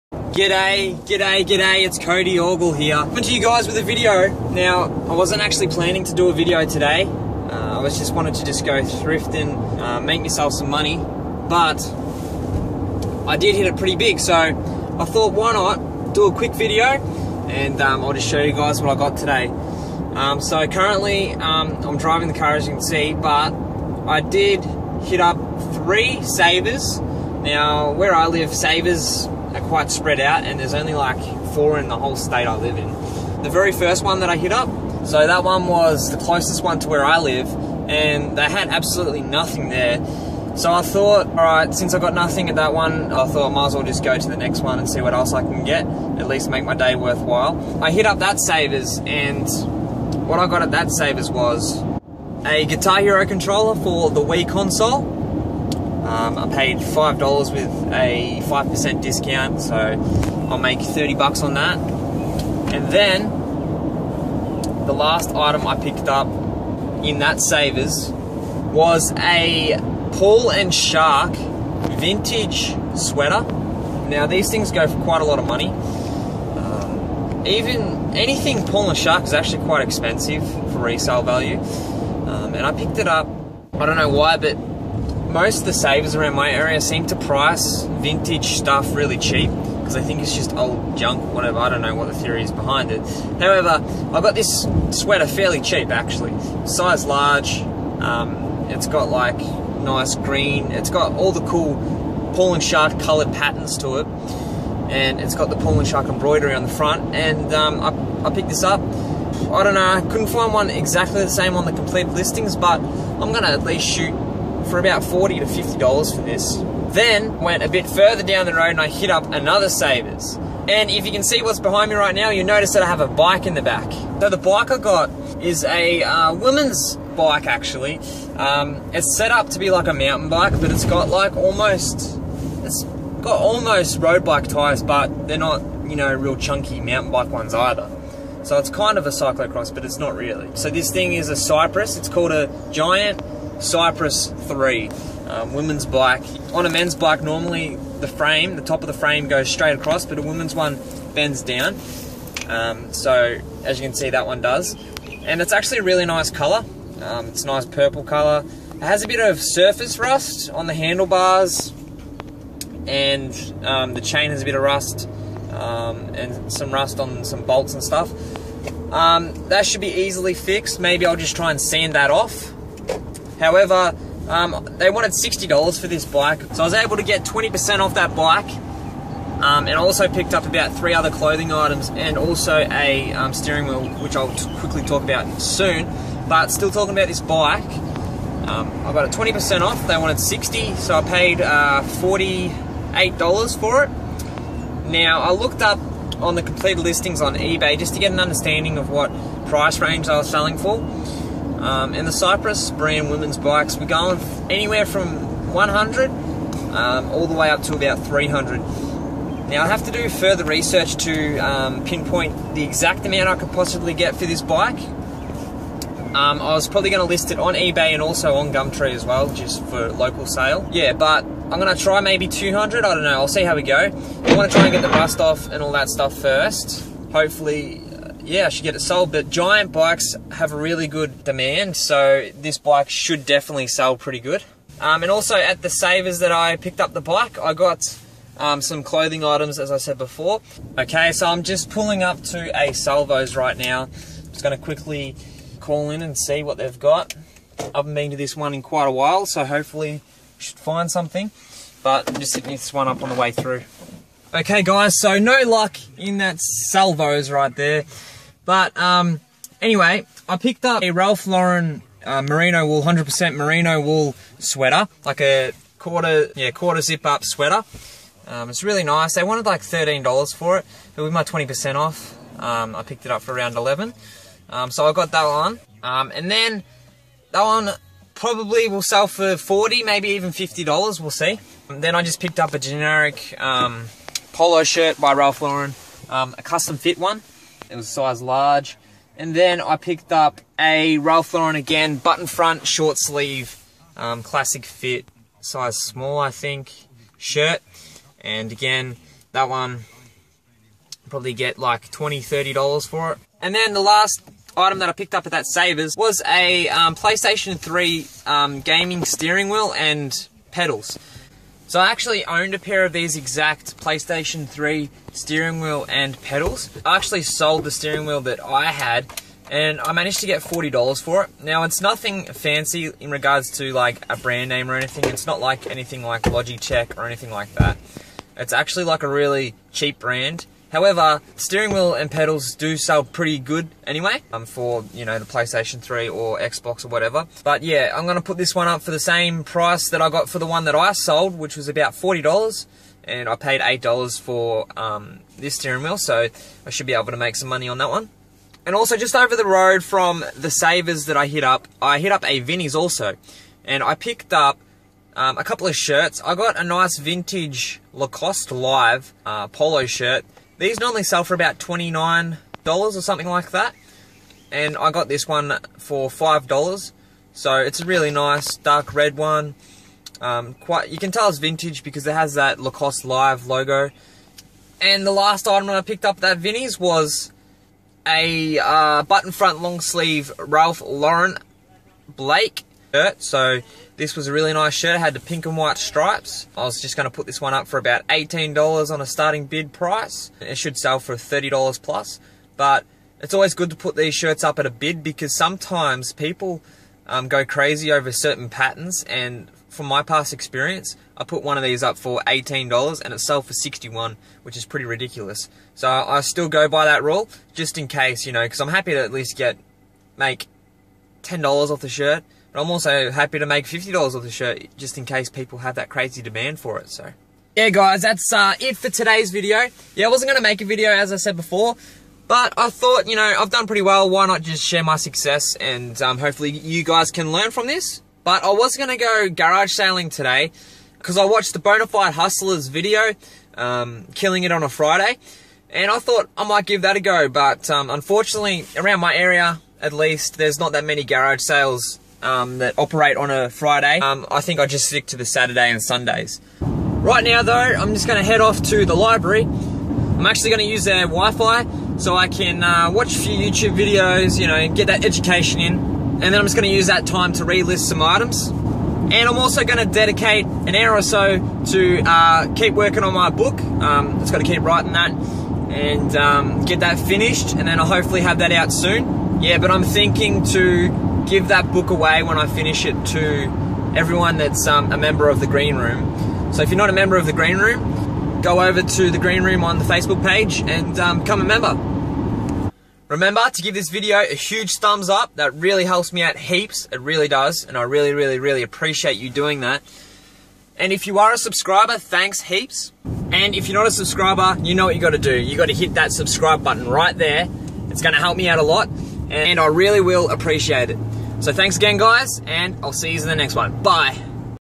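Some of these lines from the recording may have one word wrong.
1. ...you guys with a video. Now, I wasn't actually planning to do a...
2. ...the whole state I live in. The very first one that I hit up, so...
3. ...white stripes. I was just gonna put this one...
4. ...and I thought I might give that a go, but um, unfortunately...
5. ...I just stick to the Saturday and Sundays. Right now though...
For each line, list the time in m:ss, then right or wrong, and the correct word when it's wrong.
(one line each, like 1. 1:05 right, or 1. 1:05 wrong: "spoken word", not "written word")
1. 0:03 right
2. 0:31 right
3. 6:25 right
4. 7:15 right
5. 7:24 right.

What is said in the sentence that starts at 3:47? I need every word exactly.
Hopefully yeah, I should get it sold.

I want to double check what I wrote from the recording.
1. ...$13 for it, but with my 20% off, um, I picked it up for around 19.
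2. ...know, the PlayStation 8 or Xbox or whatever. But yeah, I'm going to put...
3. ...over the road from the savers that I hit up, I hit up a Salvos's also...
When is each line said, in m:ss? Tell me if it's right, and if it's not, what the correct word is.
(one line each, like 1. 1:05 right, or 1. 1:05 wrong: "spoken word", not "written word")
1. 4:29 wrong: "11", not "19"
2. 5:35 wrong: "3", not "8"
3. 5:49 wrong: "Vinnie", not "Salvos".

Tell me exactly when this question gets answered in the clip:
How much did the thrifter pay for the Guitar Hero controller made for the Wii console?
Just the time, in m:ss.
0:56.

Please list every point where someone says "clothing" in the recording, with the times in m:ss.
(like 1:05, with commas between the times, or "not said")
3:01, 3:58.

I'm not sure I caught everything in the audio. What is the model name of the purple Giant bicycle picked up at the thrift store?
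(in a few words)
Cypress 3.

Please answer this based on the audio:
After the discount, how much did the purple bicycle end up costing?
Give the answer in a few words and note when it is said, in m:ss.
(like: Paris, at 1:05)
$48, at 3:11.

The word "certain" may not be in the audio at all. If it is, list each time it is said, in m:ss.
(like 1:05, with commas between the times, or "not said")
6:38.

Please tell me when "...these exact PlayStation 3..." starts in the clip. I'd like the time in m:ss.
5:12.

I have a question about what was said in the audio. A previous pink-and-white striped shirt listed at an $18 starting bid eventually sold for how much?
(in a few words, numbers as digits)
$61.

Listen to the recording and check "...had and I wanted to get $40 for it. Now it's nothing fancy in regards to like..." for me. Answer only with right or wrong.
wrong.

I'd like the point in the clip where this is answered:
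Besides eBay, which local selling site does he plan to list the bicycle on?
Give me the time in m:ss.
3:38.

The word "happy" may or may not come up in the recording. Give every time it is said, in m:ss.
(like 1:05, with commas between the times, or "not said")
6:48, 6:53.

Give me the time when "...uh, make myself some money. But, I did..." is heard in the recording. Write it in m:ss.
0:09.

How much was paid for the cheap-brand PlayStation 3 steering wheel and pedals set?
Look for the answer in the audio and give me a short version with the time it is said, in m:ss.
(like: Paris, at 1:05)
$8, at 5:43.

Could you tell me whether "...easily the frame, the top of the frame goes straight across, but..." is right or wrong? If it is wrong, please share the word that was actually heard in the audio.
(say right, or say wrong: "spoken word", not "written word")
wrong: "normally", not "easily".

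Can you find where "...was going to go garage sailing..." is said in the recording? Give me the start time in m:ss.
7:08.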